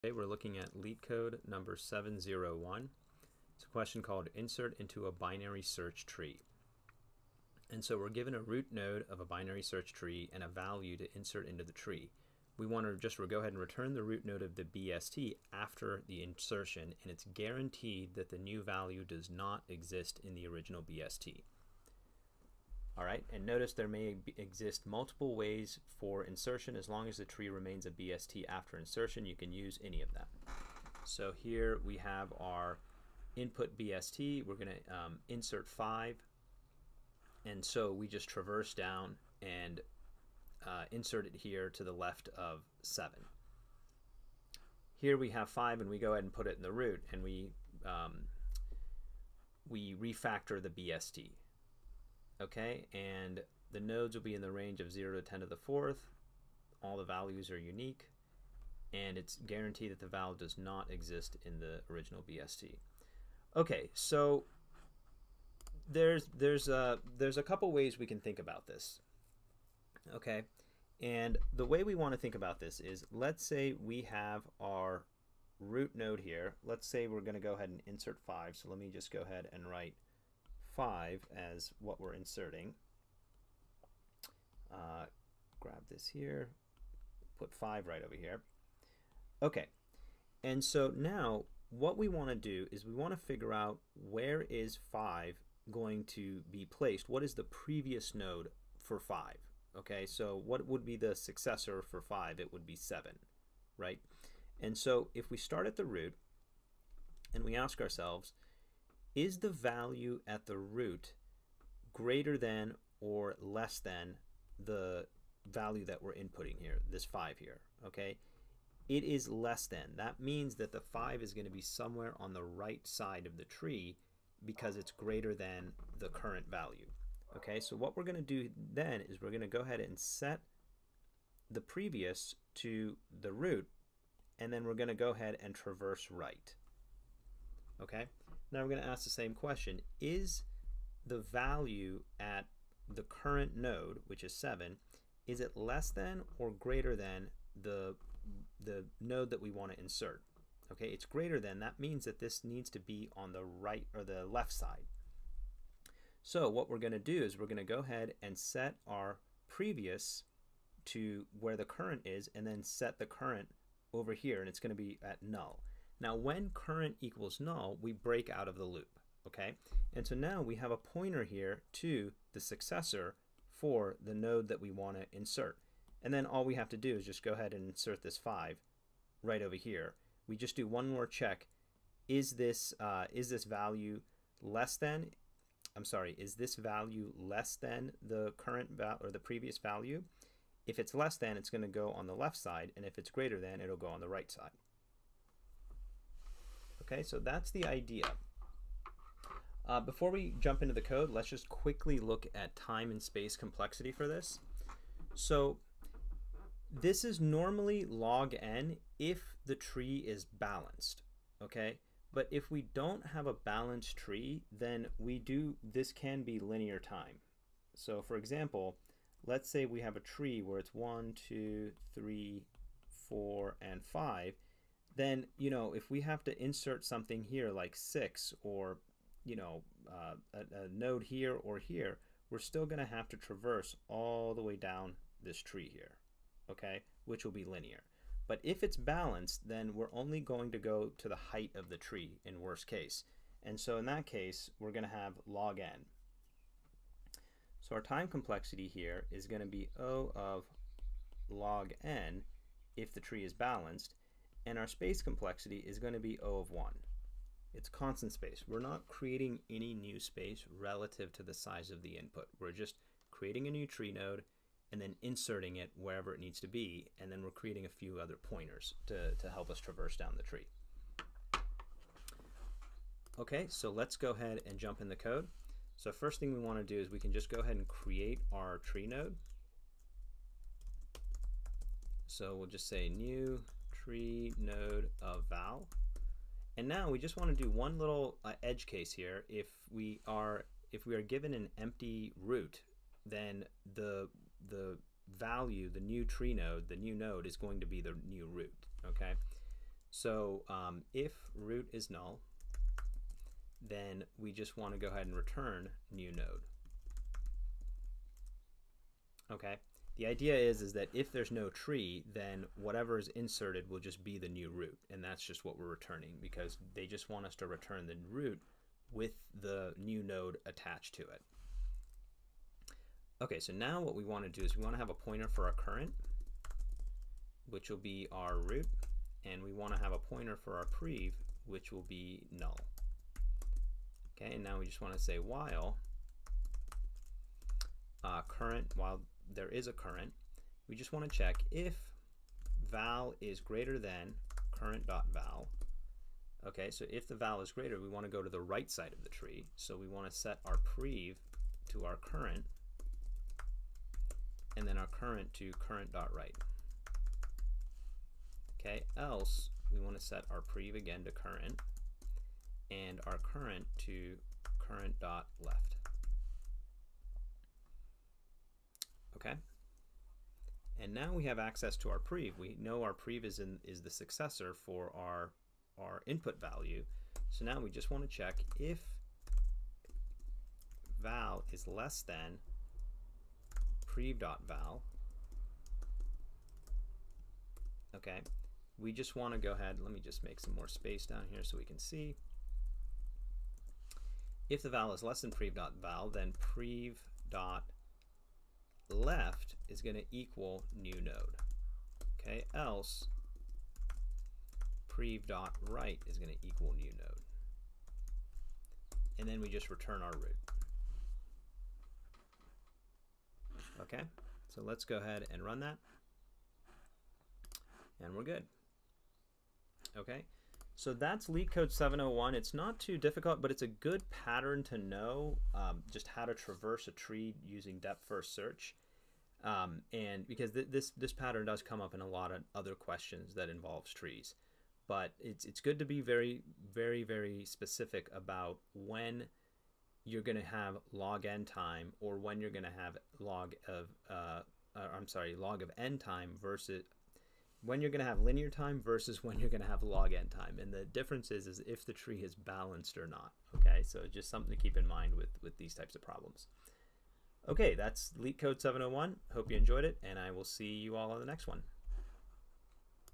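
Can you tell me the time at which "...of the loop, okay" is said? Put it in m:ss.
2:48.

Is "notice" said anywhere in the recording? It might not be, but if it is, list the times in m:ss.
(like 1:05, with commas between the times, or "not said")
0:23.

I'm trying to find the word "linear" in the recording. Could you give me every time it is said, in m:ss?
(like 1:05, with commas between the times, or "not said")
3:36, 3:57, 7:28.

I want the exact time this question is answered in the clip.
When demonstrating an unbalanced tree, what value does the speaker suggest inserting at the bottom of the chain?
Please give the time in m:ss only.
3:47.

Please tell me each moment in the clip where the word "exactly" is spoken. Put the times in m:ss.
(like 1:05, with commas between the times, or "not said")
not said.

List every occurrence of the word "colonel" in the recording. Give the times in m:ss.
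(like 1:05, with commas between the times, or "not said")
not said.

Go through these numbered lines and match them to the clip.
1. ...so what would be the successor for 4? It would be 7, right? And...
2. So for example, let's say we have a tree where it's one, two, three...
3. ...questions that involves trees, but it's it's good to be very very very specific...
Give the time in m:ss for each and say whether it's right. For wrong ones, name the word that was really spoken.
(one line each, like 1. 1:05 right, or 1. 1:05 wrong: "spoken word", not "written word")
1. 1:40 wrong: "5", not "4"
2. 3:37 right
3. 7:12 right.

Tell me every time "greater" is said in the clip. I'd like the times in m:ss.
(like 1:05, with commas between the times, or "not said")
1:51, 2:04, 2:26, 2:31, 3:13, 5:43, 5:47.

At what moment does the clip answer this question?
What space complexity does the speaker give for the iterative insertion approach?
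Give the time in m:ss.
4:16.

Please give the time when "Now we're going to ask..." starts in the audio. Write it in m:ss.
2:18.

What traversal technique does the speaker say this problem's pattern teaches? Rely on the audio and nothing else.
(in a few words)
depth first search.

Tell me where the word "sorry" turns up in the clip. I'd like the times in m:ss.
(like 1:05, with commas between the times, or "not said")
3:05, 7:25.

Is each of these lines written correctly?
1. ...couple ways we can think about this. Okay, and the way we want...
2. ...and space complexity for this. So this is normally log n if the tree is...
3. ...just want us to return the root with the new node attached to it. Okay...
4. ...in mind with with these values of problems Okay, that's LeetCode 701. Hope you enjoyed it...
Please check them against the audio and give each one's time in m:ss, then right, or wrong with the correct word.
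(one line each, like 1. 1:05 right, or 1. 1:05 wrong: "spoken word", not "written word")
1. 1:07 right
2. 3:22 right
3. 5:16 right
4. 7:34 wrong: "types", not "values".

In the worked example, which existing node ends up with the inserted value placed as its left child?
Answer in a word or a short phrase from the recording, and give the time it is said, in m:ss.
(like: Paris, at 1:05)
7, at 0:41.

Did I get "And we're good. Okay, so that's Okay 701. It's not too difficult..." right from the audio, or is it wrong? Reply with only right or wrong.
wrong.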